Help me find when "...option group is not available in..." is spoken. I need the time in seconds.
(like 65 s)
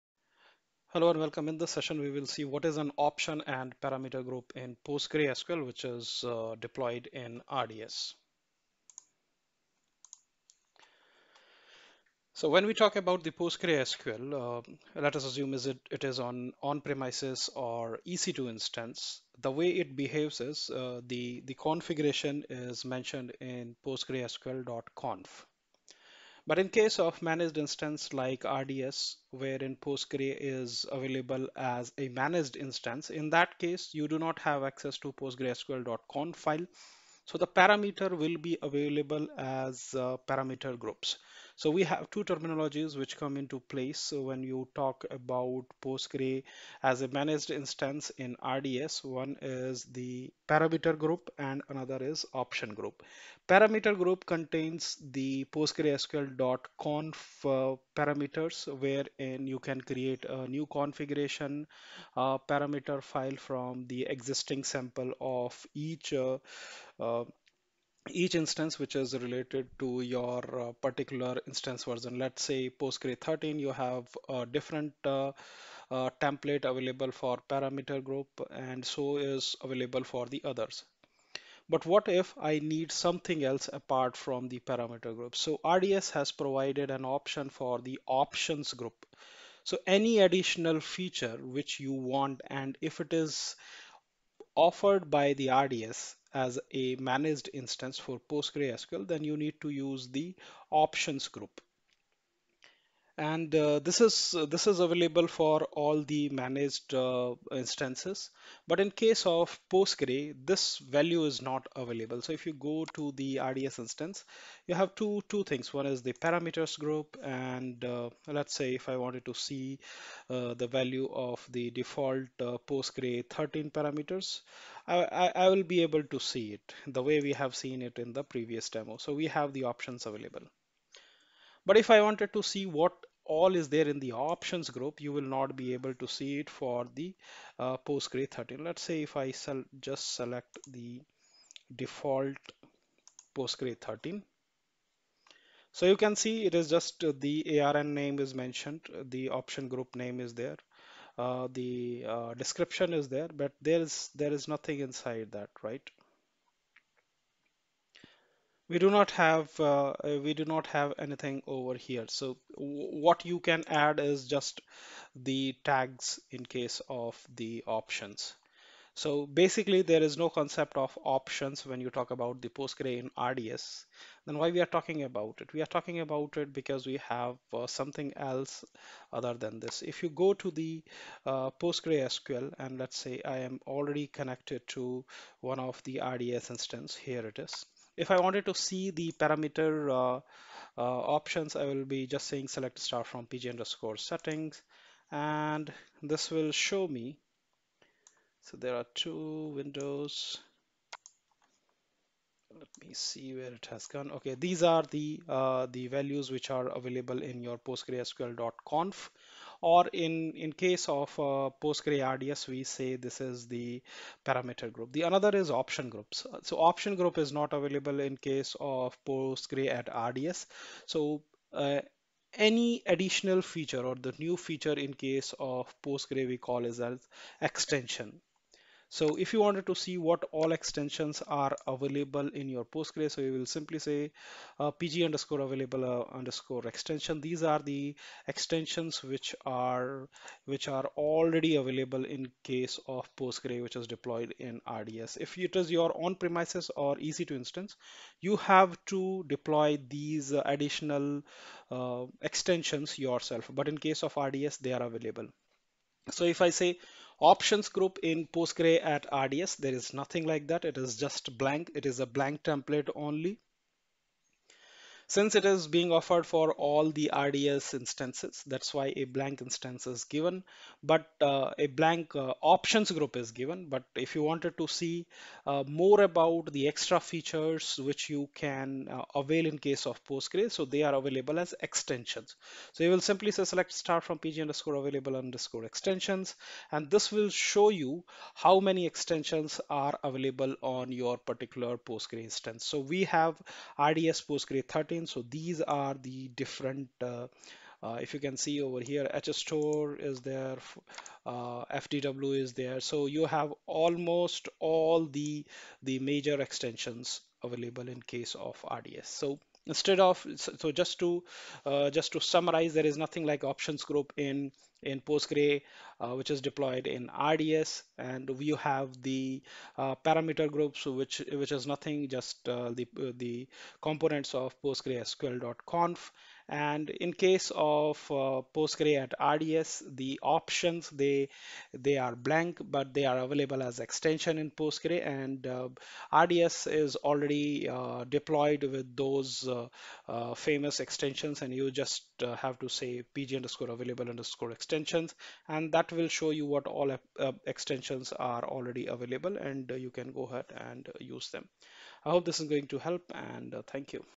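216 s.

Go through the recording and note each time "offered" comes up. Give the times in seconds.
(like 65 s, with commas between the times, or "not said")
94 s, 265 s.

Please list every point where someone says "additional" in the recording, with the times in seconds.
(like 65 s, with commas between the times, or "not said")
90 s, 222 s, 250 s.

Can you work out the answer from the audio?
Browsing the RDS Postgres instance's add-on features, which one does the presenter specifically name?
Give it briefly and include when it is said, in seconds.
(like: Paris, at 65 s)
HStore, at 299 s.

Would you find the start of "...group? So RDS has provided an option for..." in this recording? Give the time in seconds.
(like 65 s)
85 s.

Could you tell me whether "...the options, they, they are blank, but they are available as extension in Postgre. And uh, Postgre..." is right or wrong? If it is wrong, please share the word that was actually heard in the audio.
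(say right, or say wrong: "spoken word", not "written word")
wrong: "RDS", not "Postgre".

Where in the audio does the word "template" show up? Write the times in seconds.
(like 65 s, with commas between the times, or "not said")
76 s, 262 s.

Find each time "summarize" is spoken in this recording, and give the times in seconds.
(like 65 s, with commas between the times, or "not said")
312 s.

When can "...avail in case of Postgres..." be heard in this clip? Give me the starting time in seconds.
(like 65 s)
279 s.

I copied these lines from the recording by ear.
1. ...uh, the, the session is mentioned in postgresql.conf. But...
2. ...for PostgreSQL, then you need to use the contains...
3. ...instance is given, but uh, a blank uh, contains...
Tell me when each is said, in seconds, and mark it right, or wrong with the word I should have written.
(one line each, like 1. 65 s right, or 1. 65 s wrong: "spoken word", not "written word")
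1. 20 s wrong: "configuration", not "session"
2. 97 s wrong: "options", not "contains"
3. 269 s wrong: "options", not "contains".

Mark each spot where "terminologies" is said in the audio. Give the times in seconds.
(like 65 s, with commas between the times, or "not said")
42 s.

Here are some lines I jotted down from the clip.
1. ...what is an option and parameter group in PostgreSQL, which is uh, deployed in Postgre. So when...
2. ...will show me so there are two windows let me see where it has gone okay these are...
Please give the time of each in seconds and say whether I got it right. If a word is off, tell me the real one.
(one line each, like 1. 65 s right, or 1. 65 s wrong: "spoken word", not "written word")
1. 2 s wrong: "RDS", not "Postgre"
2. 196 s right.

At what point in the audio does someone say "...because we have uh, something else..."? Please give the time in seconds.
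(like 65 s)
176 s.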